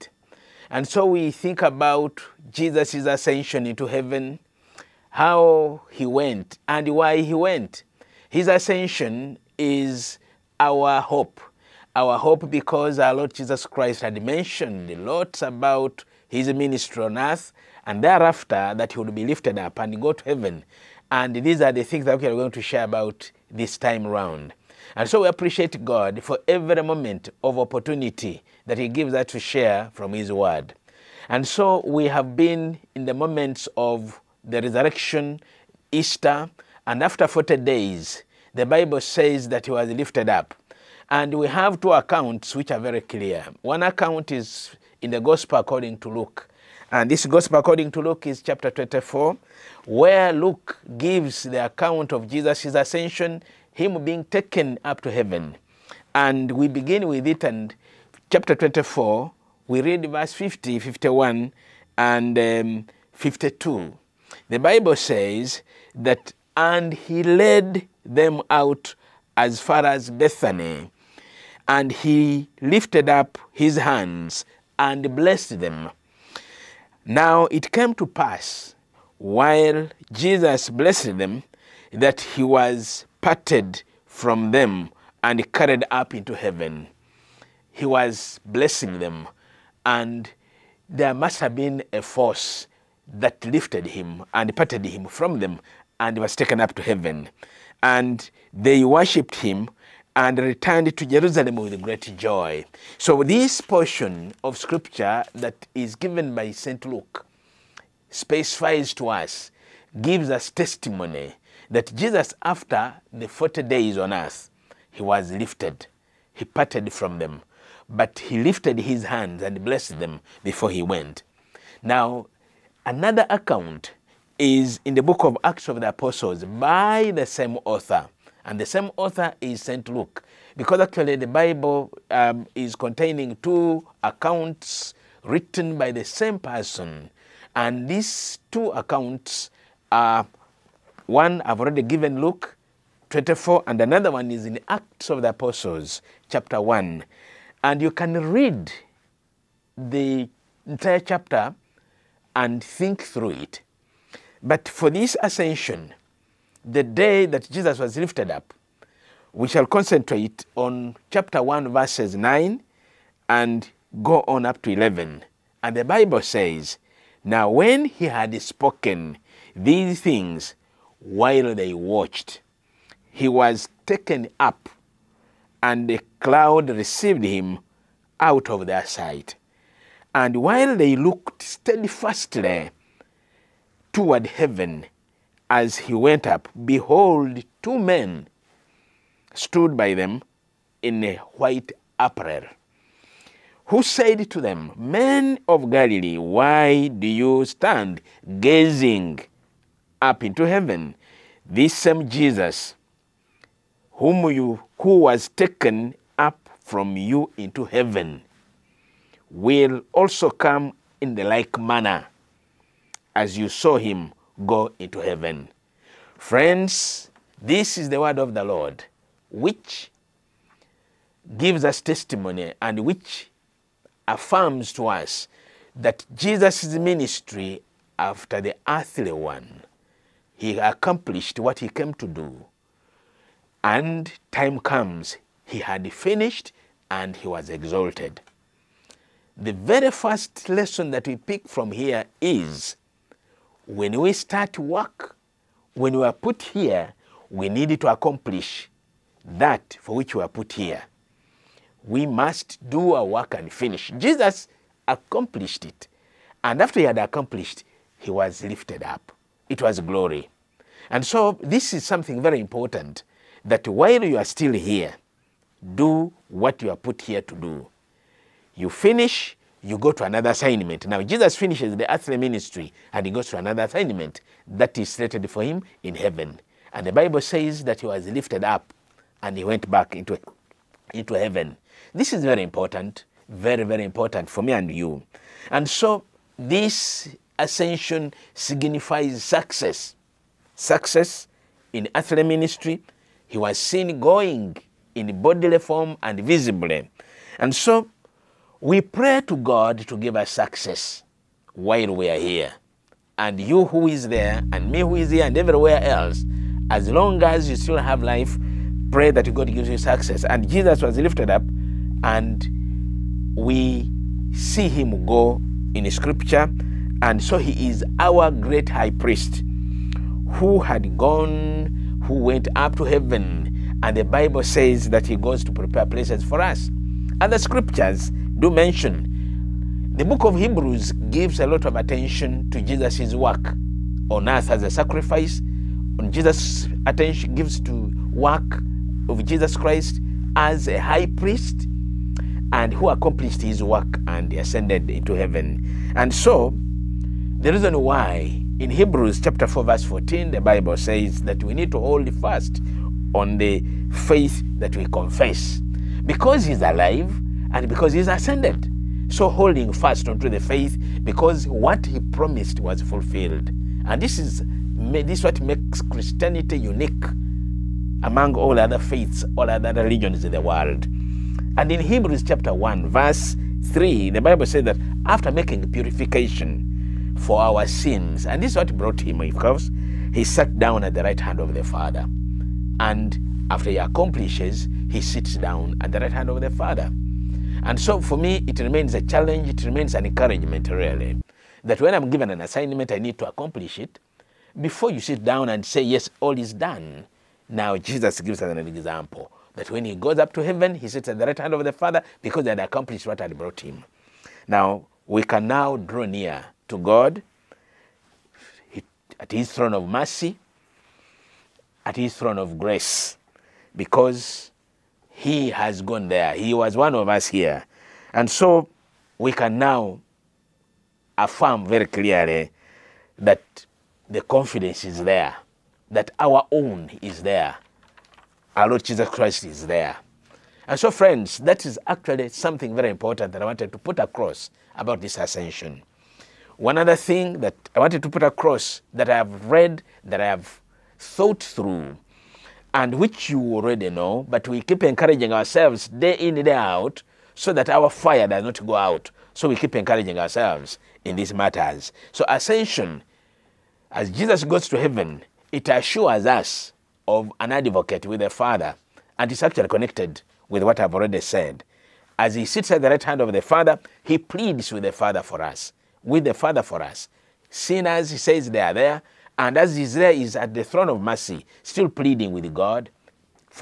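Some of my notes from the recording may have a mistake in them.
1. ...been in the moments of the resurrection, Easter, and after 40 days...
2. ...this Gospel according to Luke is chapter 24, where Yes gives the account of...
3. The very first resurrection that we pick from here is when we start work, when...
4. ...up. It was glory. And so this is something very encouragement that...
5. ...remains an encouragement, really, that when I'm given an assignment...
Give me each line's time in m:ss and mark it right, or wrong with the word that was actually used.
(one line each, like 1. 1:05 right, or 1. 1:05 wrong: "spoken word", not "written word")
1. 0:32 right
2. 0:47 wrong: "Luke", not "Yes"
3. 3:59 wrong: "lesson", not "resurrection"
4. 4:18 wrong: "important", not "encouragement"
5. 6:29 right.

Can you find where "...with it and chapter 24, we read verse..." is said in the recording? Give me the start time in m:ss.
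0:57.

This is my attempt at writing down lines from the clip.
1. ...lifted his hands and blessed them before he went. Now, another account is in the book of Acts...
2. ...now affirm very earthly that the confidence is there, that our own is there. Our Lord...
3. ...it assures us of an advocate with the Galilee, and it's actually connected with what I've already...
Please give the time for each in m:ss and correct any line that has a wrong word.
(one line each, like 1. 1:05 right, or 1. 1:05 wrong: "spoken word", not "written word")
1. 1:58 right
2. 6:59 wrong: "clearly", not "earthly"
3. 7:35 wrong: "Father", not "Galilee".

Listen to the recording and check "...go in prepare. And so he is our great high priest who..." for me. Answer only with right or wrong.
wrong.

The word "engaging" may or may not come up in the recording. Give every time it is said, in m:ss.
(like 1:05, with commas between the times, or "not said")
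not said.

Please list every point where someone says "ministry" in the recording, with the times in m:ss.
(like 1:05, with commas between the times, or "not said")
0:16, 3:46, 4:32, 4:52.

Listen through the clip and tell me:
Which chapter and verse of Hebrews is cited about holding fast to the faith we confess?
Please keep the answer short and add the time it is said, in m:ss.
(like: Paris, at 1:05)
Chapter 4 verse 14, at 5:49.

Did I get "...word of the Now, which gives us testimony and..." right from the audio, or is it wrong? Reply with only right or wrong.
wrong.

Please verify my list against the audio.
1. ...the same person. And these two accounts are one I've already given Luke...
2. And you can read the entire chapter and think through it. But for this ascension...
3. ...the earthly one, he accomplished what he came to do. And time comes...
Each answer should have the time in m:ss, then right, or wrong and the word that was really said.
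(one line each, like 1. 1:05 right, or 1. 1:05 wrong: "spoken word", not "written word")
1. 2:15 right
2. 2:27 right
3. 3:48 right.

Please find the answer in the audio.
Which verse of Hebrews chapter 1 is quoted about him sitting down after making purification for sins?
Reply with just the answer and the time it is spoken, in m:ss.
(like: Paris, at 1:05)
Verse 3, at 6:12.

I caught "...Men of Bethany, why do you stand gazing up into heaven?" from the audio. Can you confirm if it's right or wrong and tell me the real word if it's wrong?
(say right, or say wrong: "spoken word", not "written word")
wrong: "Galilee", not "Bethany".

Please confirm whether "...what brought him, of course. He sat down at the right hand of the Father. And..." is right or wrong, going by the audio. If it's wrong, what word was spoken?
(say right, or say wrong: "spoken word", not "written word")
right.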